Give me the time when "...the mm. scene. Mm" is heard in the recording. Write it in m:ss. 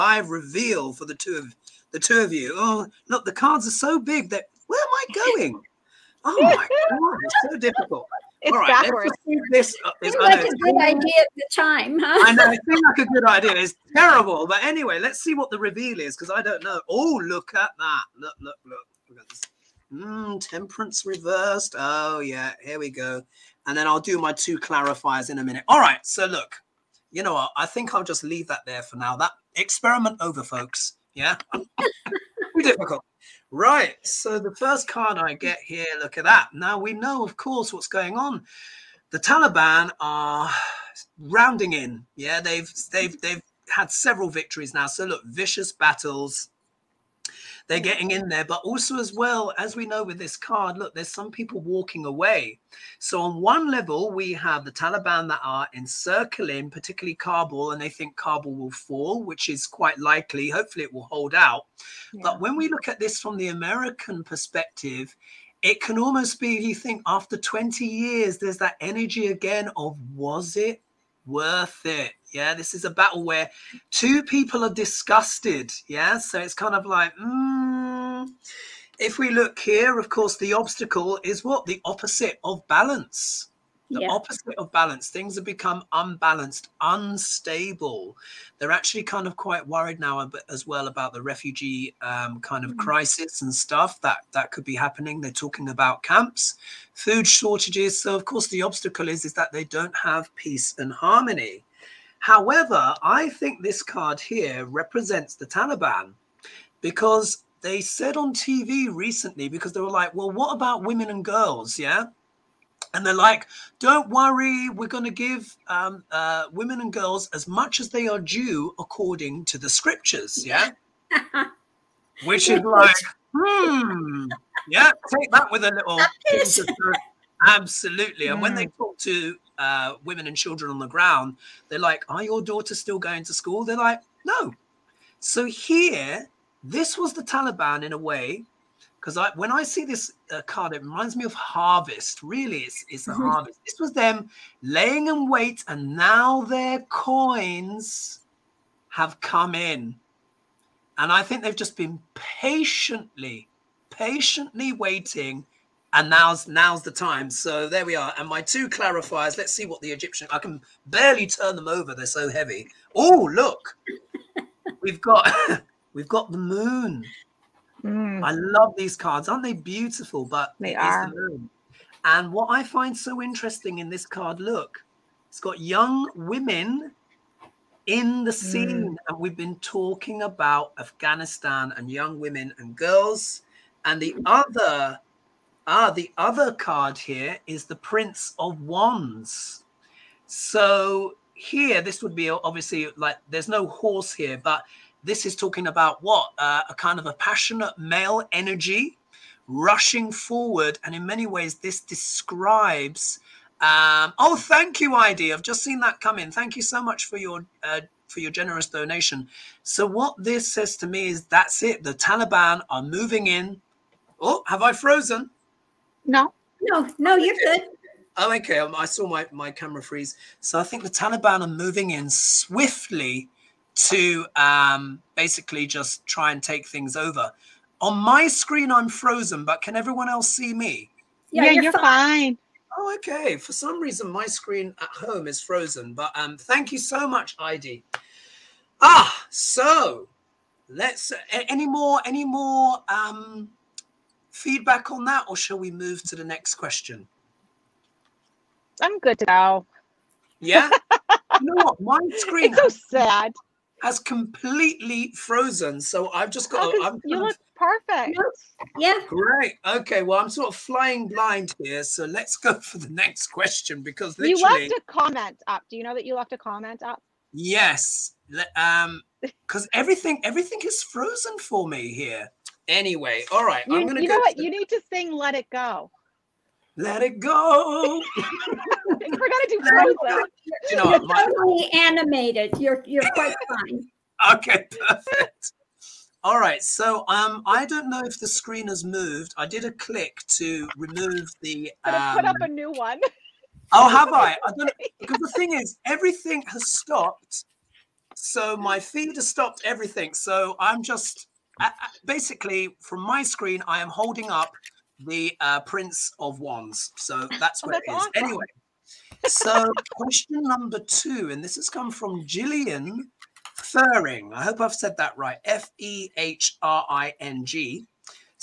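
2:58.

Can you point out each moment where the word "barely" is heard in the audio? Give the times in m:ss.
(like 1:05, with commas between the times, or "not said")
2:40.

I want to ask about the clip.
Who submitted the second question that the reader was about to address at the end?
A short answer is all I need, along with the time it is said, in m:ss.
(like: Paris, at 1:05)
Gillian Fehring, at 5:12.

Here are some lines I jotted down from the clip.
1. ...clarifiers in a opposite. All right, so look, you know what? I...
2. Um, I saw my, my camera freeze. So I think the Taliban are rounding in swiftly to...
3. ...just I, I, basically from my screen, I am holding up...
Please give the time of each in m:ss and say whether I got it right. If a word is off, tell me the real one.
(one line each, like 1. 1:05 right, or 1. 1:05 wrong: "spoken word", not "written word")
1. 0:24 wrong: "minute", not "opposite"
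2. 3:38 wrong: "moving", not "rounding"
3. 5:00 right.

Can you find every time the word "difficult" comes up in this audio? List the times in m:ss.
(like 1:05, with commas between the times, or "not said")
0:07, 0:32.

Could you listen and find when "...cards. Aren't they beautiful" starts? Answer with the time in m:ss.
2:48.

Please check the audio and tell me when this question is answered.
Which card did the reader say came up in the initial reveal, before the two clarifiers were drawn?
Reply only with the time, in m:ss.
0:20.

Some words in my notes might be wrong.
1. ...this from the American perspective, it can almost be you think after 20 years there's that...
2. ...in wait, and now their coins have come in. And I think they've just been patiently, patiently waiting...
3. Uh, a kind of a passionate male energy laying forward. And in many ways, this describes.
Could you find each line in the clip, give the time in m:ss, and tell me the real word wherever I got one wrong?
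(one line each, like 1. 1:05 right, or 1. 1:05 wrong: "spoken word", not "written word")
1. 1:02 right
2. 2:25 right
3. 3:16 wrong: "rushing", not "laying".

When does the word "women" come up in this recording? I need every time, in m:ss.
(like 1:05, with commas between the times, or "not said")
1:50, 1:56, 2:10, 2:56, 3:02.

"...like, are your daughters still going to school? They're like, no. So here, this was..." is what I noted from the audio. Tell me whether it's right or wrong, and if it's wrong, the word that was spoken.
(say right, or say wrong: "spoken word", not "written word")
right.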